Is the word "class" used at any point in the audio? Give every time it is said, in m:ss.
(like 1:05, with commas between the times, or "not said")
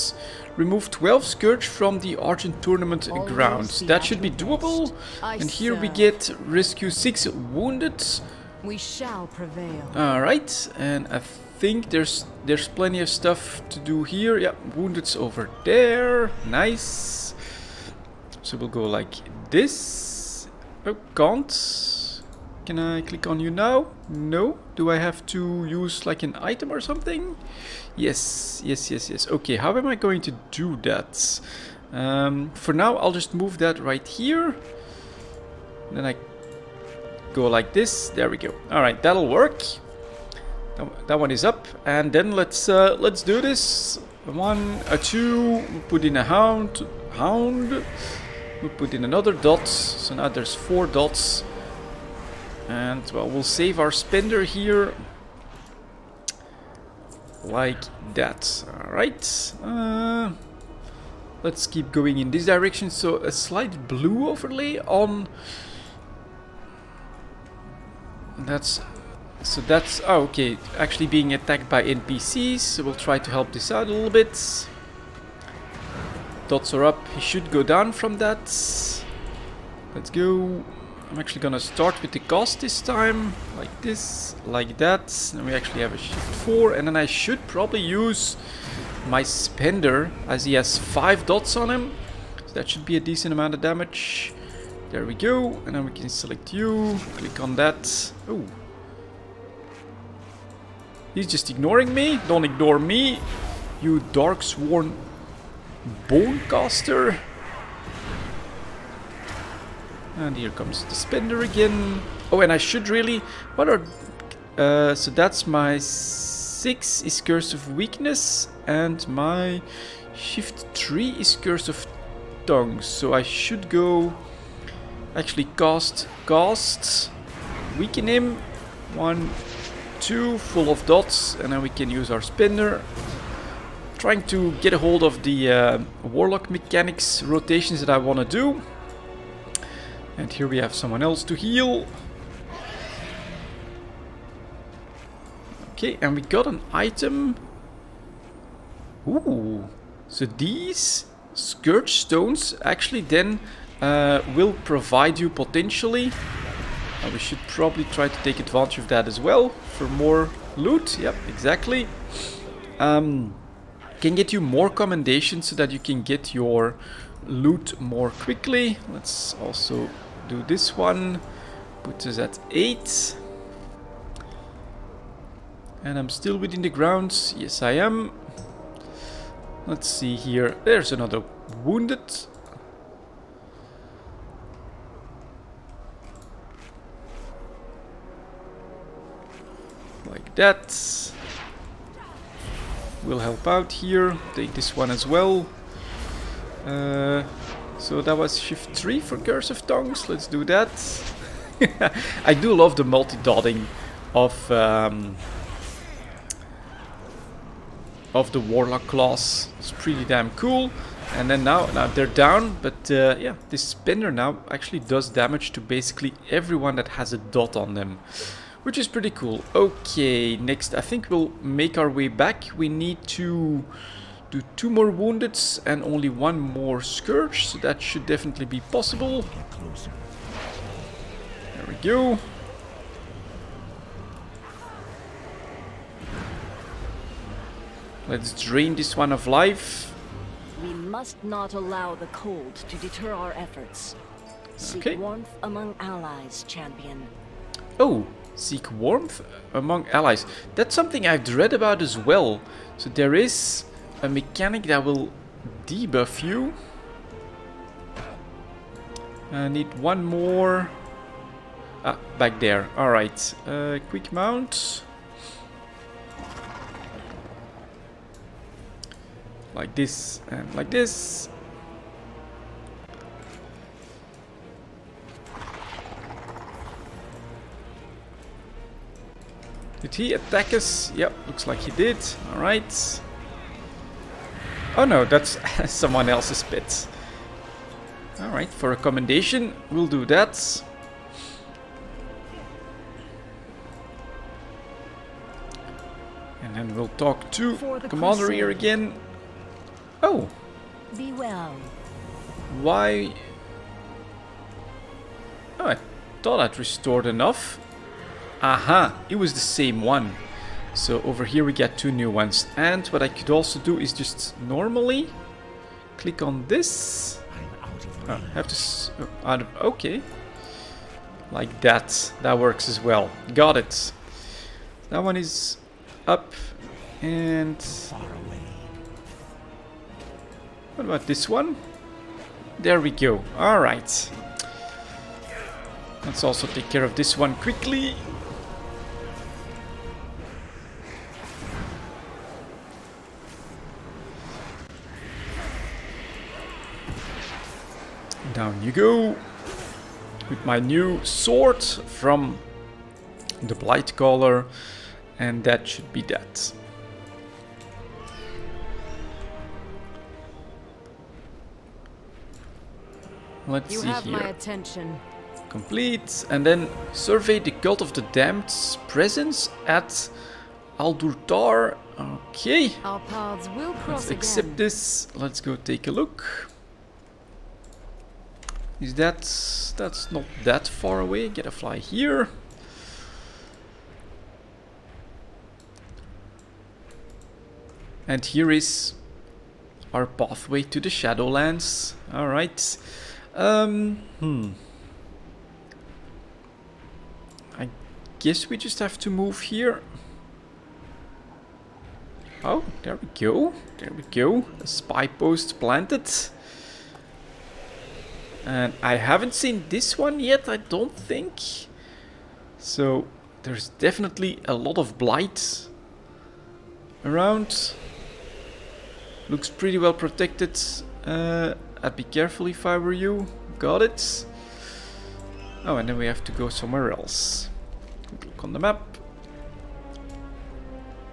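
3:28.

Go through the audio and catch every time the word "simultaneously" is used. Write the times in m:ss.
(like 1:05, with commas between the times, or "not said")
not said.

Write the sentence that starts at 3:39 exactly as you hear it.
Okay, next, I think we'll make our way back.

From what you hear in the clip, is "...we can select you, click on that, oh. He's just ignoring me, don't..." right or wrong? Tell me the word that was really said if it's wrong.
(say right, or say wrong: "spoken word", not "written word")
right.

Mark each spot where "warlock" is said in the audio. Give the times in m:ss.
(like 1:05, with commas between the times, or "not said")
2:16, 3:28.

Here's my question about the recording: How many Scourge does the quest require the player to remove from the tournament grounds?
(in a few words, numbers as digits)
12.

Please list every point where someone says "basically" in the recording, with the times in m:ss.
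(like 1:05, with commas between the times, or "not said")
3:35.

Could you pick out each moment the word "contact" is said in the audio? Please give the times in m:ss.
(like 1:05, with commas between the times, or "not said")
not said.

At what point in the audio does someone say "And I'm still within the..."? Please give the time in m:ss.
2:55.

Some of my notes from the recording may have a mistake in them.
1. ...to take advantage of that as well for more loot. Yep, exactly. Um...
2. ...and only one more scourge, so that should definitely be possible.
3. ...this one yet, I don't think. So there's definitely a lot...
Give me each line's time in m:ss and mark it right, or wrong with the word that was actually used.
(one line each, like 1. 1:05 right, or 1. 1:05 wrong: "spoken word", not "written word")
1. 2:38 right
2. 3:45 right
3. 6:49 right.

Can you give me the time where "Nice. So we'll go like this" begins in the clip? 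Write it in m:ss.
0:16.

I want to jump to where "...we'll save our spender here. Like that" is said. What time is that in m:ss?
0:53.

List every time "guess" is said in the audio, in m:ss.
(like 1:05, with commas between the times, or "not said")
6:38.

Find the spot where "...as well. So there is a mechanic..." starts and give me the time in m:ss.
4:11.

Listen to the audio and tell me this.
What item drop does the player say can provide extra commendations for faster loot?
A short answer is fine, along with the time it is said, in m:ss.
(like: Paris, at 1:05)
Scourge Stones, at 2:31.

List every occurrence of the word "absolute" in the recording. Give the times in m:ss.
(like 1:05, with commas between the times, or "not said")
not said.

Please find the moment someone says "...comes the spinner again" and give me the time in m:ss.
1:50.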